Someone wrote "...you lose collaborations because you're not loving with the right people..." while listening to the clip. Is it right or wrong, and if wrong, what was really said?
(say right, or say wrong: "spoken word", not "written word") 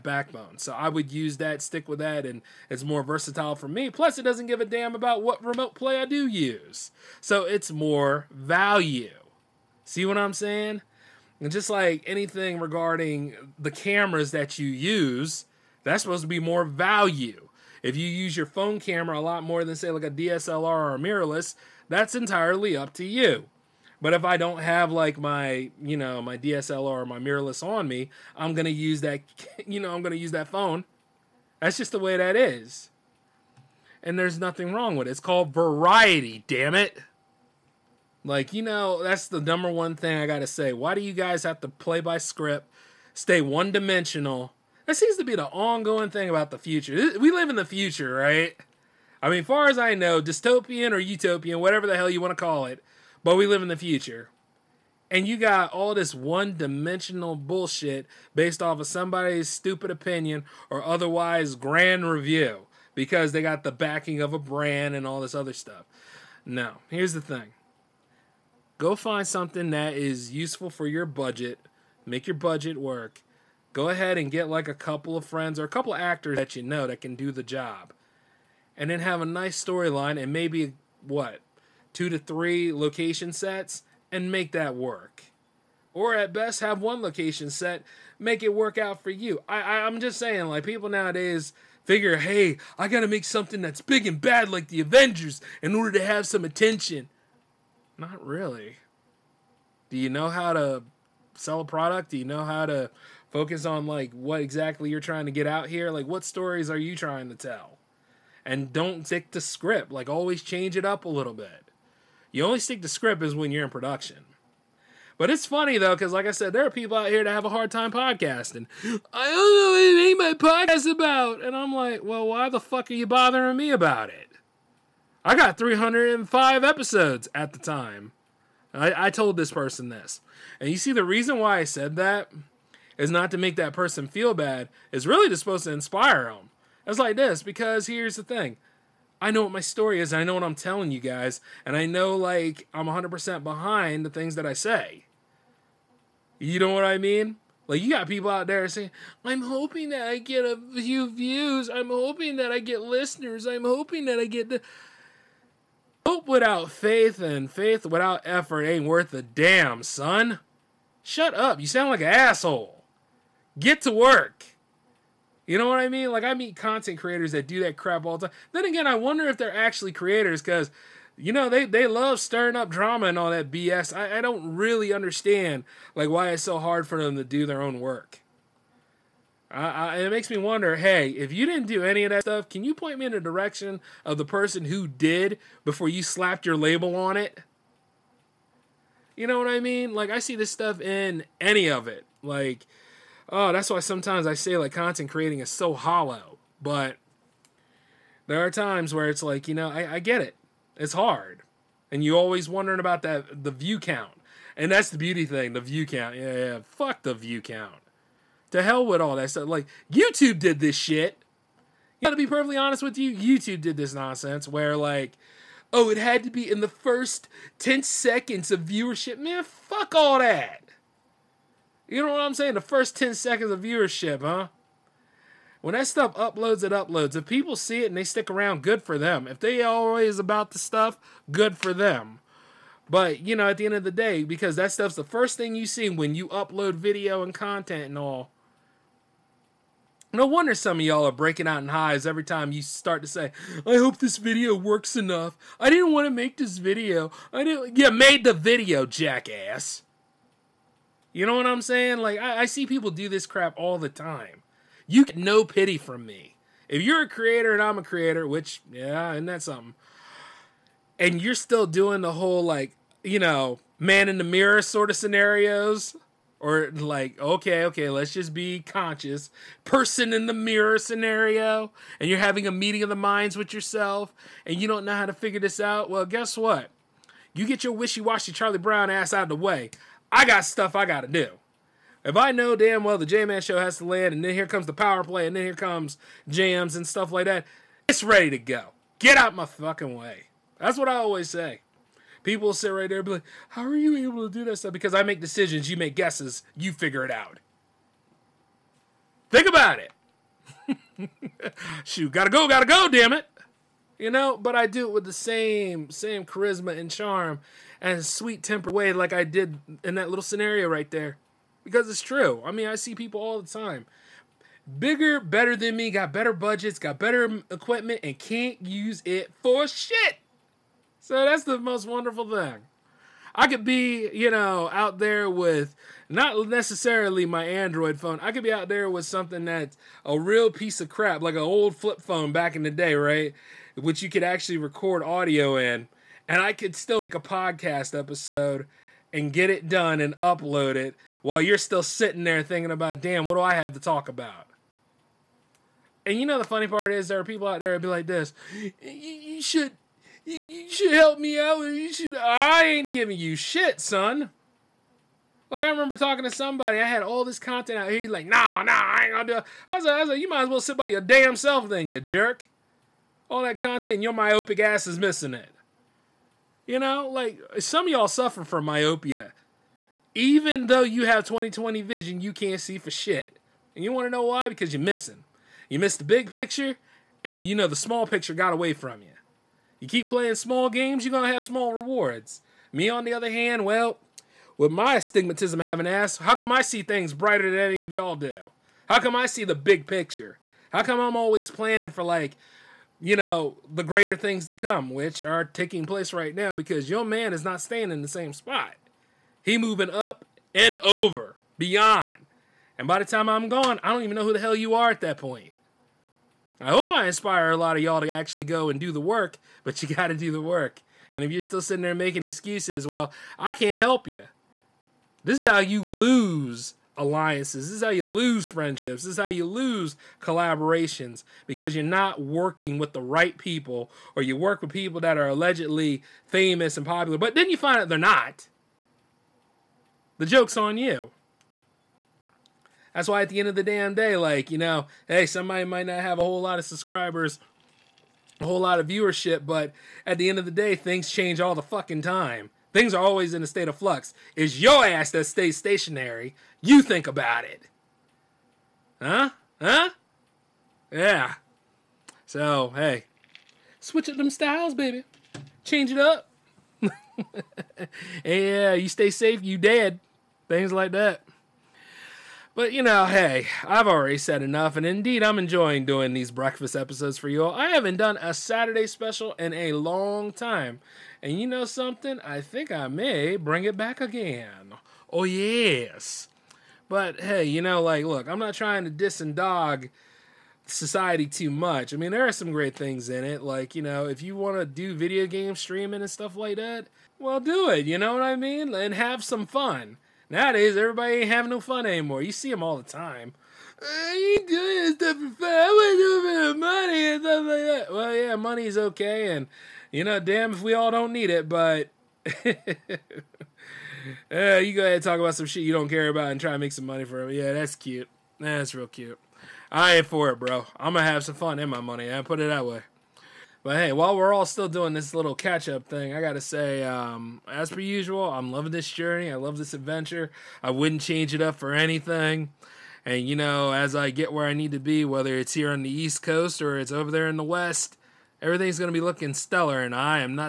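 wrong: "working", not "loving".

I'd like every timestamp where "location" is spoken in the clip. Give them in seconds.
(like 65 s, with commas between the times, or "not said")
82 s, 86 s.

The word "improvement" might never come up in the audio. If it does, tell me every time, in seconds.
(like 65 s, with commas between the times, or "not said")
not said.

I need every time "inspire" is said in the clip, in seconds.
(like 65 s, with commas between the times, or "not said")
135 s, 407 s.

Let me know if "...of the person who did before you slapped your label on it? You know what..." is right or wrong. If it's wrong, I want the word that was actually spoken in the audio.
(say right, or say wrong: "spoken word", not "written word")
right.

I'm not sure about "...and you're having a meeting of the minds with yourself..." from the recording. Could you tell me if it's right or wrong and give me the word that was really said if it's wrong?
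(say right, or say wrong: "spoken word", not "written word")
right.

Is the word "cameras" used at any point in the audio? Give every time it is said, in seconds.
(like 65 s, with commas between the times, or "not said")
13 s, 18 s.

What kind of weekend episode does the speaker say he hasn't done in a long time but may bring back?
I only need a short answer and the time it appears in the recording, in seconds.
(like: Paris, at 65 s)
Saturday special, at 468 s.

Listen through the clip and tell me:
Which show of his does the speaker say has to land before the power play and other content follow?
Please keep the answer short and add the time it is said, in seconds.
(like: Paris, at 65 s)
The J Man show, at 283 s.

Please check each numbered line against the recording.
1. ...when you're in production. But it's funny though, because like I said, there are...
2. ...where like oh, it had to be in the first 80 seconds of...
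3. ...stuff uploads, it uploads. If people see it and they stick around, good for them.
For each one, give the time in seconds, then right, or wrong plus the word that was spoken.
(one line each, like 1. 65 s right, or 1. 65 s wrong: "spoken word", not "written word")
1. 113 s right
2. 214 s wrong: "10", not "80"
3. 225 s right.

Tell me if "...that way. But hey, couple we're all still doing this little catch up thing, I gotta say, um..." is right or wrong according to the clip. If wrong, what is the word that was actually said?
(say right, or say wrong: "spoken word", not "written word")
wrong: "while", not "couple".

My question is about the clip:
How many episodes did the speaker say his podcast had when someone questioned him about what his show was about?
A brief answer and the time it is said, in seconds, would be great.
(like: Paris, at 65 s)
305, at 125 s.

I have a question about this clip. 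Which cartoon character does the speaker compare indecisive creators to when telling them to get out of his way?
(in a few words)
Charlie Brown.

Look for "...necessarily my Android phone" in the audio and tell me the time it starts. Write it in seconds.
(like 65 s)
326 s.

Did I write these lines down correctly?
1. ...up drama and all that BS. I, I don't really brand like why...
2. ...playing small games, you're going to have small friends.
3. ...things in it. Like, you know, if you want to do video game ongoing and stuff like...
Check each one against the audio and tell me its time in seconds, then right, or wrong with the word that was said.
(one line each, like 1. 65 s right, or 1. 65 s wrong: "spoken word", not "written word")
1. 172 s wrong: "understand", not "brand"
2. 380 s wrong: "rewards", not "friends"
3. 482 s wrong: "streaming", not "ongoing".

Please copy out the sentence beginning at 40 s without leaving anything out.
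Why do you guys have to play by script, stay one dimensional?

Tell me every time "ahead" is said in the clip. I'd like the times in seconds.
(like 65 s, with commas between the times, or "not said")
73 s, 504 s.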